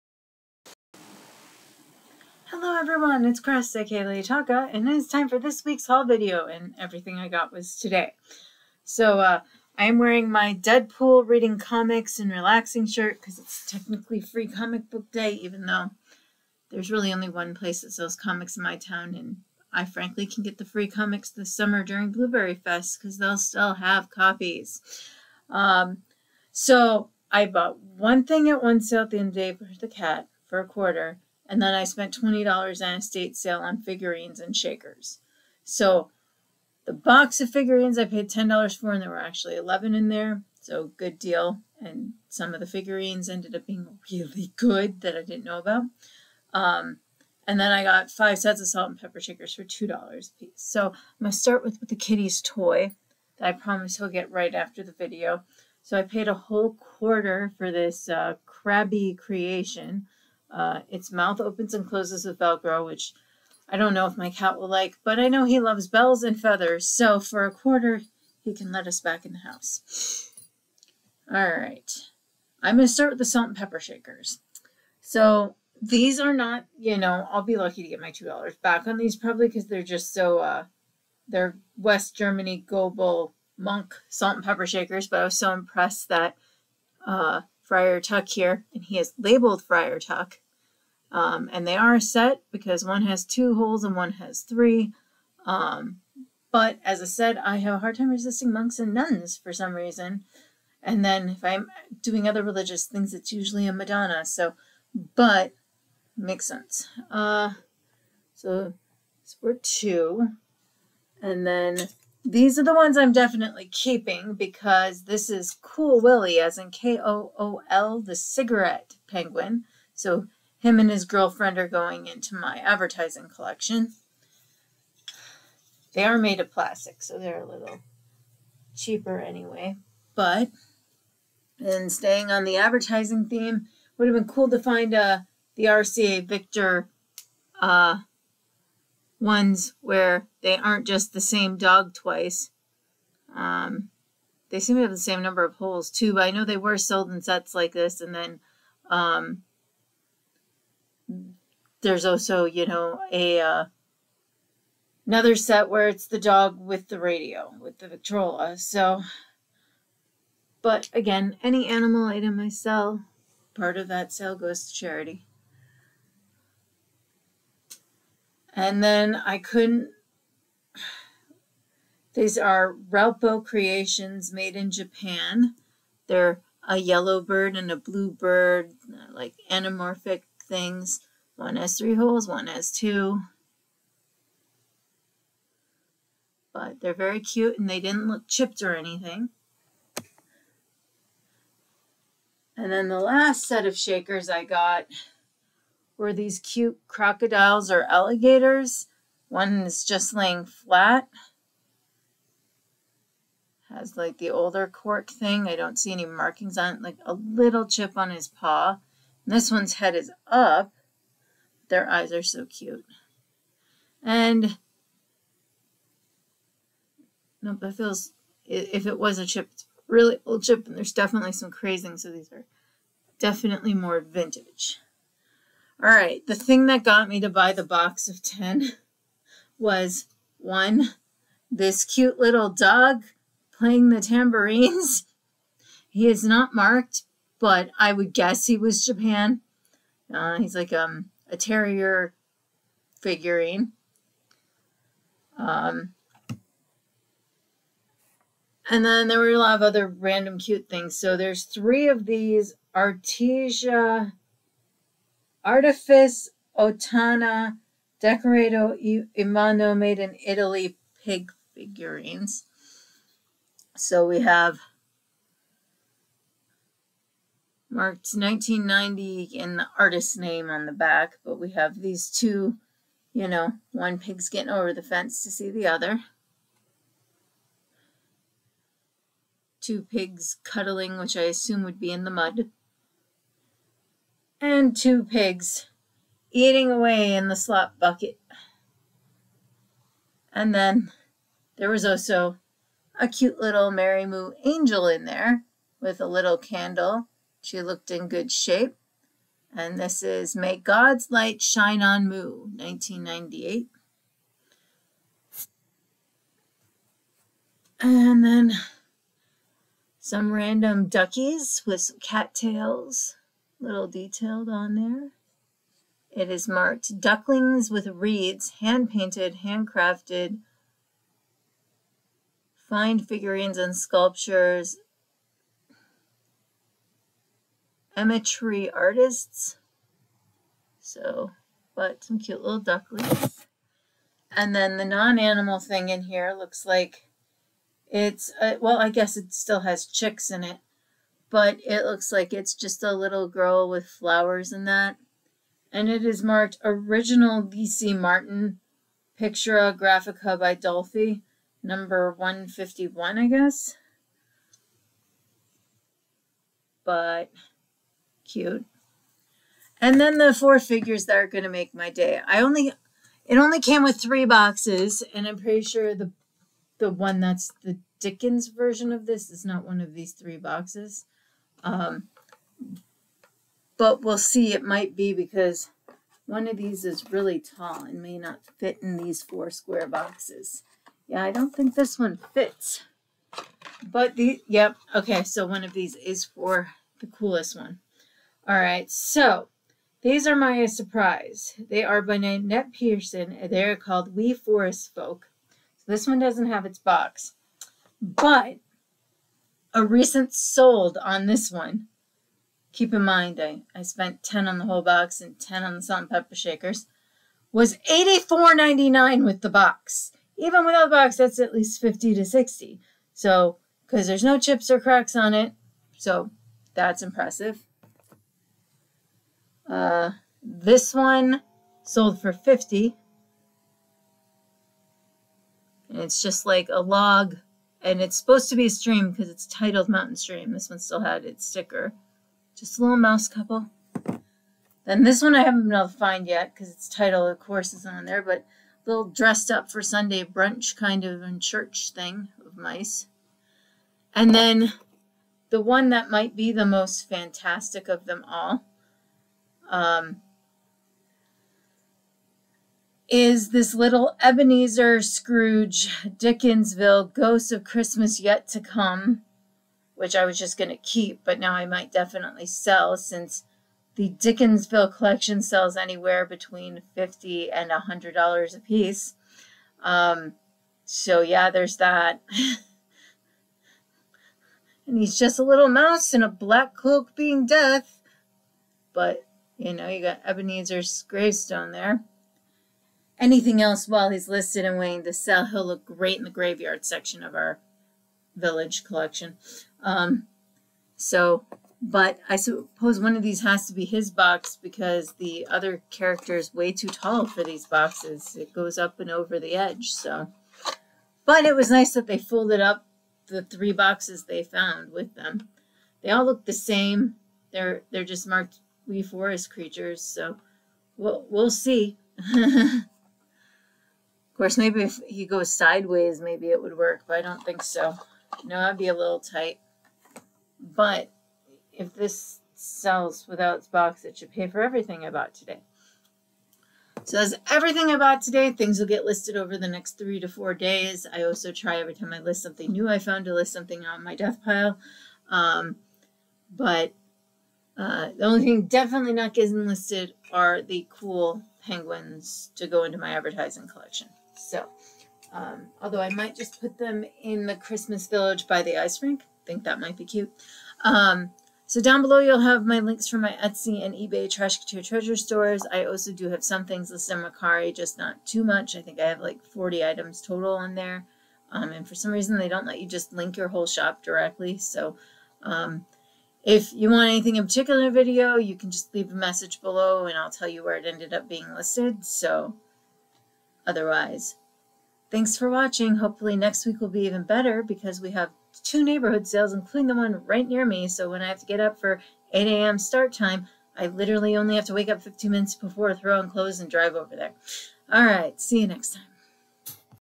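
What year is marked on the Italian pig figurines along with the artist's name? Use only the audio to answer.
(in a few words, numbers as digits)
1990.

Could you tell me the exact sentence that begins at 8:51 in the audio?
I also try every time I list something new I found to list something on my death pile.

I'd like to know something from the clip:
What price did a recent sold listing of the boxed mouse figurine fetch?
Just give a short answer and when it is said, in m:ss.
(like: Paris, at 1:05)
$84.99, at 6:47.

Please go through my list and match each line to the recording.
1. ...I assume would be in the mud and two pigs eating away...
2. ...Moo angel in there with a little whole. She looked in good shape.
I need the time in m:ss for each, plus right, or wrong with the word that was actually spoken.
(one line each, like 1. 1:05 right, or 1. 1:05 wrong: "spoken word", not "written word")
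1. 4:41 right
2. 4:54 wrong: "candle", not "whole".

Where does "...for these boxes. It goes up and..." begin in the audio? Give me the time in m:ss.
8:17.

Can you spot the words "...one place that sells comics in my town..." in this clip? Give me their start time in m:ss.
0:17.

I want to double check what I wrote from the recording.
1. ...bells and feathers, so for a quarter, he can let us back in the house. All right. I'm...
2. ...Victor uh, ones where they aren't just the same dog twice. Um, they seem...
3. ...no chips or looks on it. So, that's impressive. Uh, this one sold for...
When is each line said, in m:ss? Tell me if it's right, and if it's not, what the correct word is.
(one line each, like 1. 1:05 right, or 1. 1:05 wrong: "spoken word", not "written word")
1. 1:05 right
2. 2:16 right
3. 6:54 wrong: "cracks", not "looks".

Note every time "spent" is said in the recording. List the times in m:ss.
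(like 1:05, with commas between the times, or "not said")
0:31, 6:43.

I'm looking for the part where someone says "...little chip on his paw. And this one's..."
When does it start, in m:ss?
3:27.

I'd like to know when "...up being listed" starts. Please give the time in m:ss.
9:31.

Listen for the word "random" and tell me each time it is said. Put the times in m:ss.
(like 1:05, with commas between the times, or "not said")
4:09, 5:10.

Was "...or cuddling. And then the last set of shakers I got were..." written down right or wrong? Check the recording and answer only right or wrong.
wrong.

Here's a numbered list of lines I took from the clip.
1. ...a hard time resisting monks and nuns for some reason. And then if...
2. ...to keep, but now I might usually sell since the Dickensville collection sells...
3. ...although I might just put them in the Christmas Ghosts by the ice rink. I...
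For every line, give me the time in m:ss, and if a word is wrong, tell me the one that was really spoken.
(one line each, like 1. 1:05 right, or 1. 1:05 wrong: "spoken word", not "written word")
1. 1:37 right
2. 7:40 wrong: "definitely", not "usually"
3. 9:05 wrong: "Village", not "Ghosts".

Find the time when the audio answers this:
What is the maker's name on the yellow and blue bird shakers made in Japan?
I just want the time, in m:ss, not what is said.
2:52.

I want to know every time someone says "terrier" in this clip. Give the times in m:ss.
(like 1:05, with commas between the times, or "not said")
4:01.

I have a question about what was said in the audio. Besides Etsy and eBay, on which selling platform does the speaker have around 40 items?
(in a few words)
Mercari.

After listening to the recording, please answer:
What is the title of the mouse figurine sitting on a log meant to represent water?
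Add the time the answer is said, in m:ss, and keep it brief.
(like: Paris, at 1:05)
Mountain Stream, at 7:09.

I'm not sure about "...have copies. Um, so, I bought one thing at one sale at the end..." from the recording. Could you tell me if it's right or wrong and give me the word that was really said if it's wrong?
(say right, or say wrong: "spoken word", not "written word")
right.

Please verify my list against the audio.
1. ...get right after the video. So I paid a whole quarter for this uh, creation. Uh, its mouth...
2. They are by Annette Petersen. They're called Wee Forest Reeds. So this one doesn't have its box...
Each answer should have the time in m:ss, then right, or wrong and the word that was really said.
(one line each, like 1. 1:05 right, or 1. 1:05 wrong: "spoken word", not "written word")
1. 0:54 right
2. 6:31 wrong: "Folk", not "Reeds".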